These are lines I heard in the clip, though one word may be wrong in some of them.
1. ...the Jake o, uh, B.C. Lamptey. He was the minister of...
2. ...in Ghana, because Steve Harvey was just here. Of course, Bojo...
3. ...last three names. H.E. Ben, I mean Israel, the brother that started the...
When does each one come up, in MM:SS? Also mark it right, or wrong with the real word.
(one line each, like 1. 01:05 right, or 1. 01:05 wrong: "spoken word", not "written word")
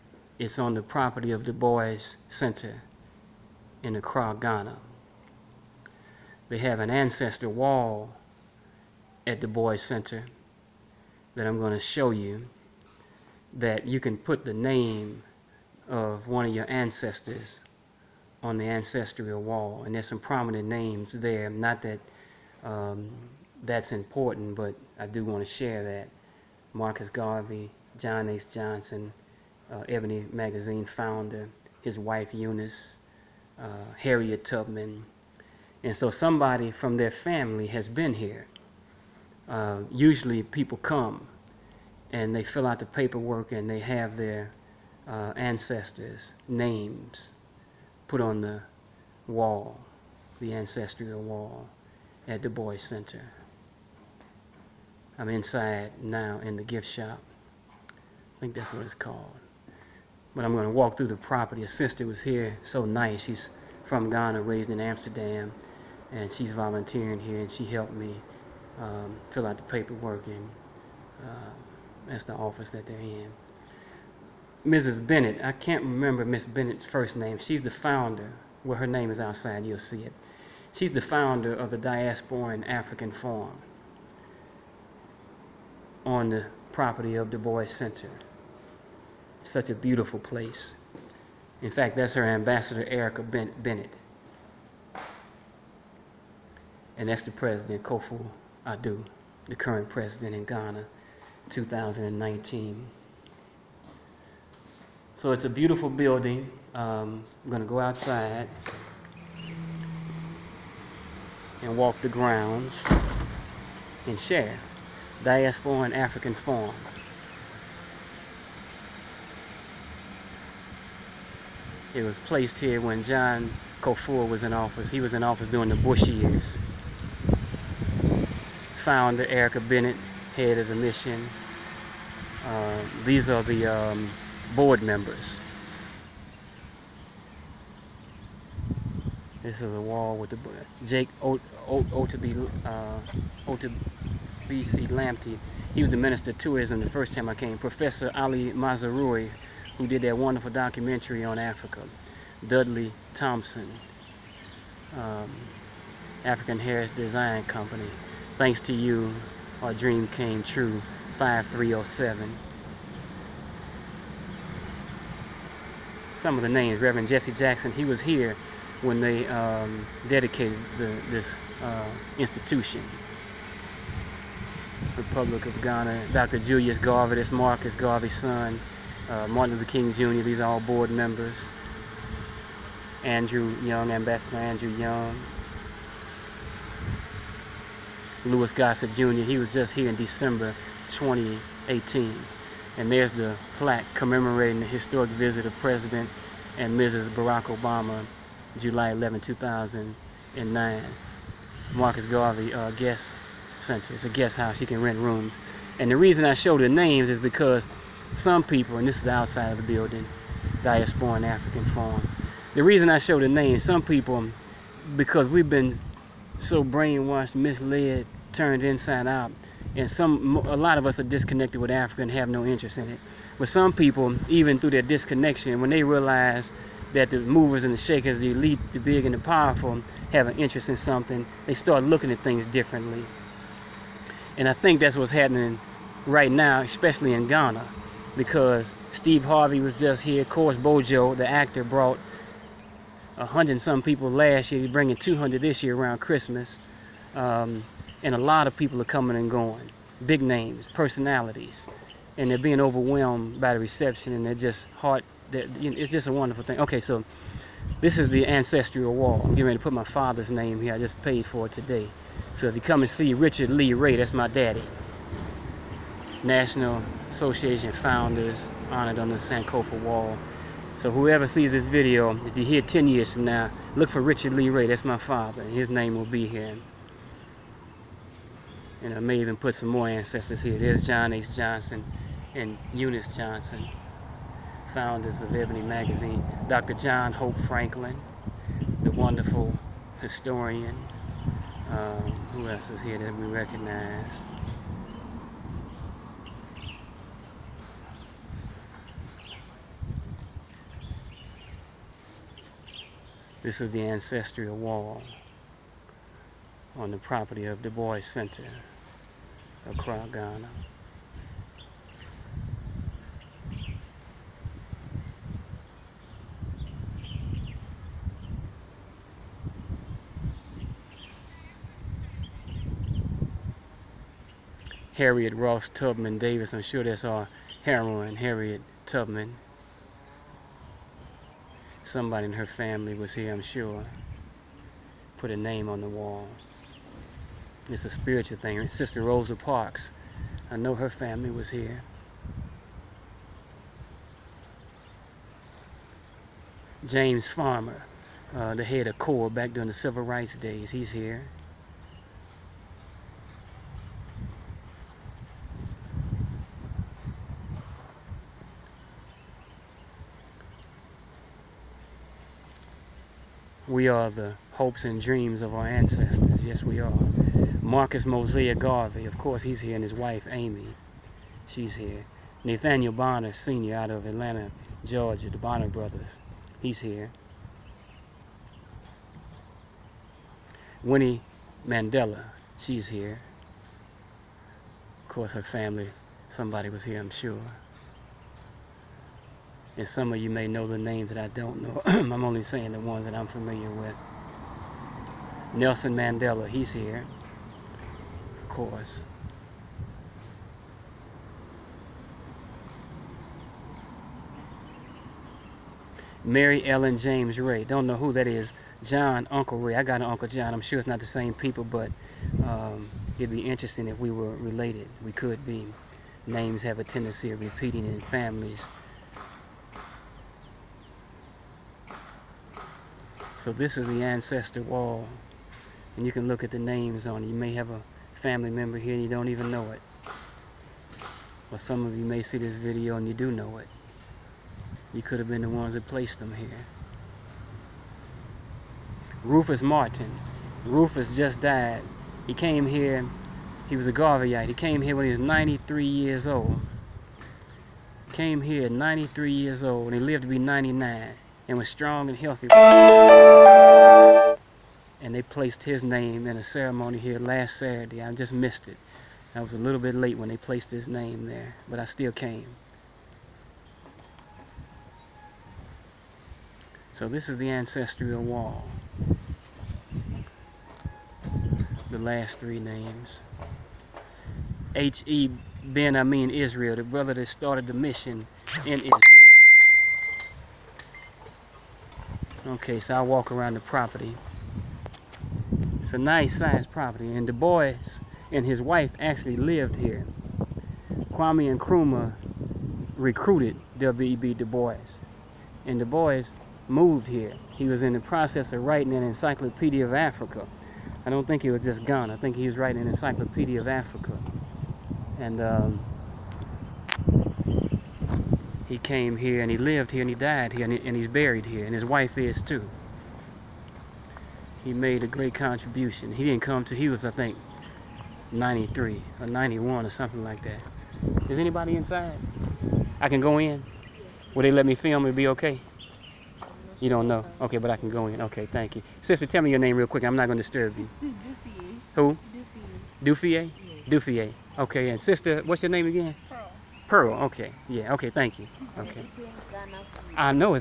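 1. 02:20 right
2. 03:57 right
3. 07:51 right.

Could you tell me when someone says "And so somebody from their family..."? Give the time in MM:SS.
00:35.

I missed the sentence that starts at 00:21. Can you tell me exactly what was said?
Not that um, that's important, but I do want to share that.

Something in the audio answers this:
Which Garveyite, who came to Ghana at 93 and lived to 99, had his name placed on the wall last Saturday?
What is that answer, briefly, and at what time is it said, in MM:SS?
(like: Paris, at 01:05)
Rufus Martin, at 07:19.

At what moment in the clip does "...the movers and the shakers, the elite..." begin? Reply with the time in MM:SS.
03:47.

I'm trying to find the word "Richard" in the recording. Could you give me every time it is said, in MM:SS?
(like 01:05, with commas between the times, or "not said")
04:23, 04:34.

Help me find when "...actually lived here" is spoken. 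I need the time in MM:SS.
08:08.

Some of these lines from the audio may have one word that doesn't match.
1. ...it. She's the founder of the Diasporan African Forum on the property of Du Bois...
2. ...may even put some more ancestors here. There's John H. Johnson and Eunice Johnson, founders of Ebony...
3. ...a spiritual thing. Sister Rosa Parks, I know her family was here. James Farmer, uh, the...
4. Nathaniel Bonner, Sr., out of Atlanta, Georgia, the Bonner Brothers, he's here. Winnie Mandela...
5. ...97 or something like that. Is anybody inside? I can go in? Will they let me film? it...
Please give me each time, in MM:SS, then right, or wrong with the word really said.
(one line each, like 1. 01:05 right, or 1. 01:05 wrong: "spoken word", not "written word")
1. 01:20 right
2. 04:38 right
3. 05:37 right
4. 06:12 right
5. 08:39 wrong: "91", not "97".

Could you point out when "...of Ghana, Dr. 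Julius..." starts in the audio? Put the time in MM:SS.
02:55.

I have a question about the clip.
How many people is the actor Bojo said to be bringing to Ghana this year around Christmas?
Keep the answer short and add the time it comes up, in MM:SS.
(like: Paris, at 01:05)
200, at 04:04.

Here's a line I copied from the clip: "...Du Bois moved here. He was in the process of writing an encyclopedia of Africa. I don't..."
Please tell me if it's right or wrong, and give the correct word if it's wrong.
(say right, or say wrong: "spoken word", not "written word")
right.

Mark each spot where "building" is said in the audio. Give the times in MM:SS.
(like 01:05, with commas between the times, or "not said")
01:45, 03:29.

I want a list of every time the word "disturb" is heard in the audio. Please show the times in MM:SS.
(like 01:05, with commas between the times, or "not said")
08:50.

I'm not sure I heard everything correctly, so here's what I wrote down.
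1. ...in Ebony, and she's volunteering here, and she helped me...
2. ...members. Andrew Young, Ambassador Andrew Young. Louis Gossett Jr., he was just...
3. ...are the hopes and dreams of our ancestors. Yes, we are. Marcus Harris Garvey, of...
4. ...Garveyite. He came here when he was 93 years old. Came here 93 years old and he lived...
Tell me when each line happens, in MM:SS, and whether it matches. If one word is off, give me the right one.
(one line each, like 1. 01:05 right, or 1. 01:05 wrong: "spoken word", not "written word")
1. 01:04 wrong: "Amsterdam", not "Ebony"
2. 03:00 right
3. 06:03 wrong: "Mosiah", not "Harris"
4. 07:23 right.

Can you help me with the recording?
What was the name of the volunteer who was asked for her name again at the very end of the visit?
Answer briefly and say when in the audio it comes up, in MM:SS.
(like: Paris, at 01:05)
Pearl, at 08:56.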